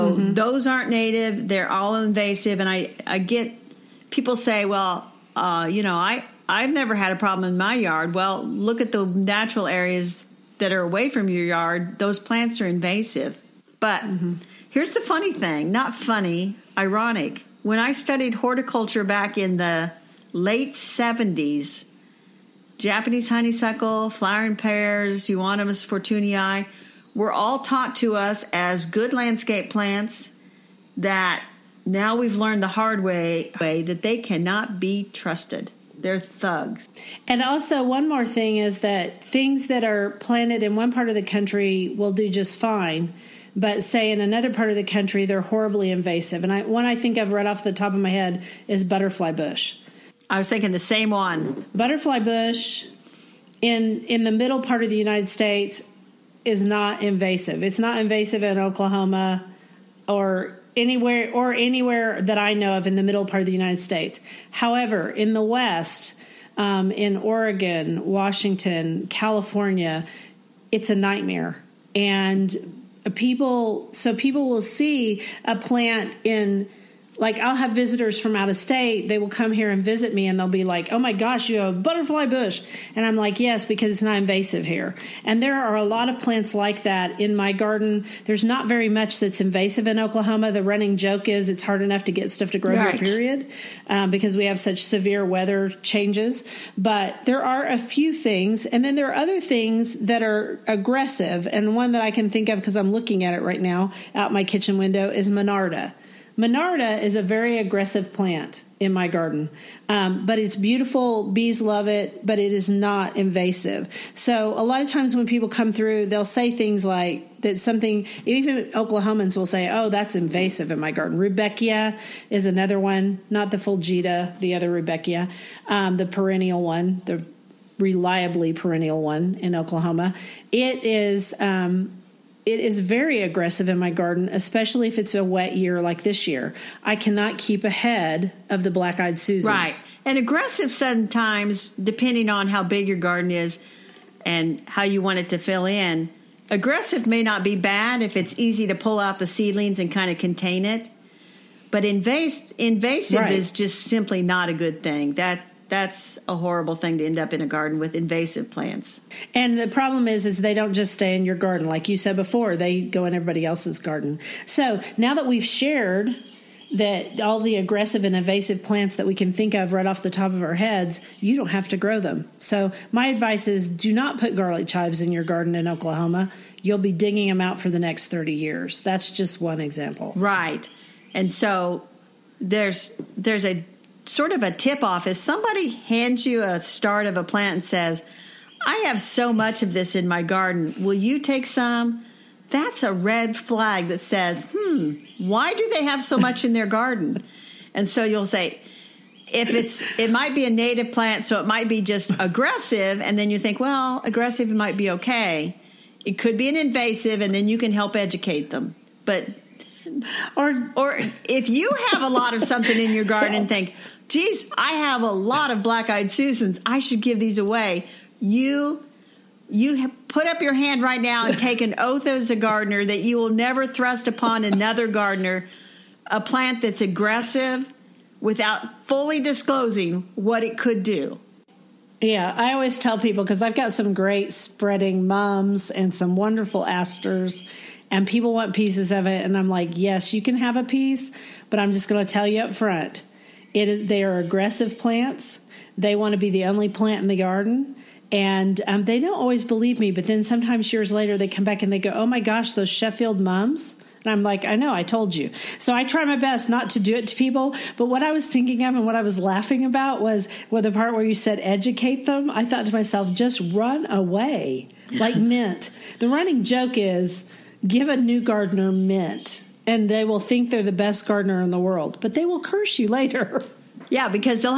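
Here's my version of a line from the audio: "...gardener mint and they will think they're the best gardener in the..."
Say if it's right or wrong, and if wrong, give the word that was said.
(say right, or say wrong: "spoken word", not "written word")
right.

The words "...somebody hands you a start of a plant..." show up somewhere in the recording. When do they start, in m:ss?
3:05.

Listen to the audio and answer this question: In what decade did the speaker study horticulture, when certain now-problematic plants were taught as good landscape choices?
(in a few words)
late 70s.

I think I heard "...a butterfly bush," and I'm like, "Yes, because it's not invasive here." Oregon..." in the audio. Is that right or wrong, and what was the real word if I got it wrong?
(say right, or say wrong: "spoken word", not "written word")
wrong: "And", not "Oregon".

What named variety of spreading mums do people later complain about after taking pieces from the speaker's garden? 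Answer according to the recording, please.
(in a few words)
Sheffield mums.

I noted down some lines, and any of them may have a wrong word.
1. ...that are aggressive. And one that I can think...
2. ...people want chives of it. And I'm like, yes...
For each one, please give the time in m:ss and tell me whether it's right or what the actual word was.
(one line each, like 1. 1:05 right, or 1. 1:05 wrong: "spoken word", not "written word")
1. 1:39 right
2. 3:58 wrong: "pieces", not "chives".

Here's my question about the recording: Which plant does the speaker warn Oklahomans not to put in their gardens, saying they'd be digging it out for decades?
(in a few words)
garlic chives.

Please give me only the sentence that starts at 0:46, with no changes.
And I, one I think I've read off the top of my head is butterfly bush.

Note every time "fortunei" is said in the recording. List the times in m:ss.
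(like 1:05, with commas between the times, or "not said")
0:25.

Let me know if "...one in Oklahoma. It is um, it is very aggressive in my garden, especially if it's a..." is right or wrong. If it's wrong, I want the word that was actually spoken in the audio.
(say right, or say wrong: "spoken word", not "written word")
right.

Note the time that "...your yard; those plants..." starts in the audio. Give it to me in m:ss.
0:11.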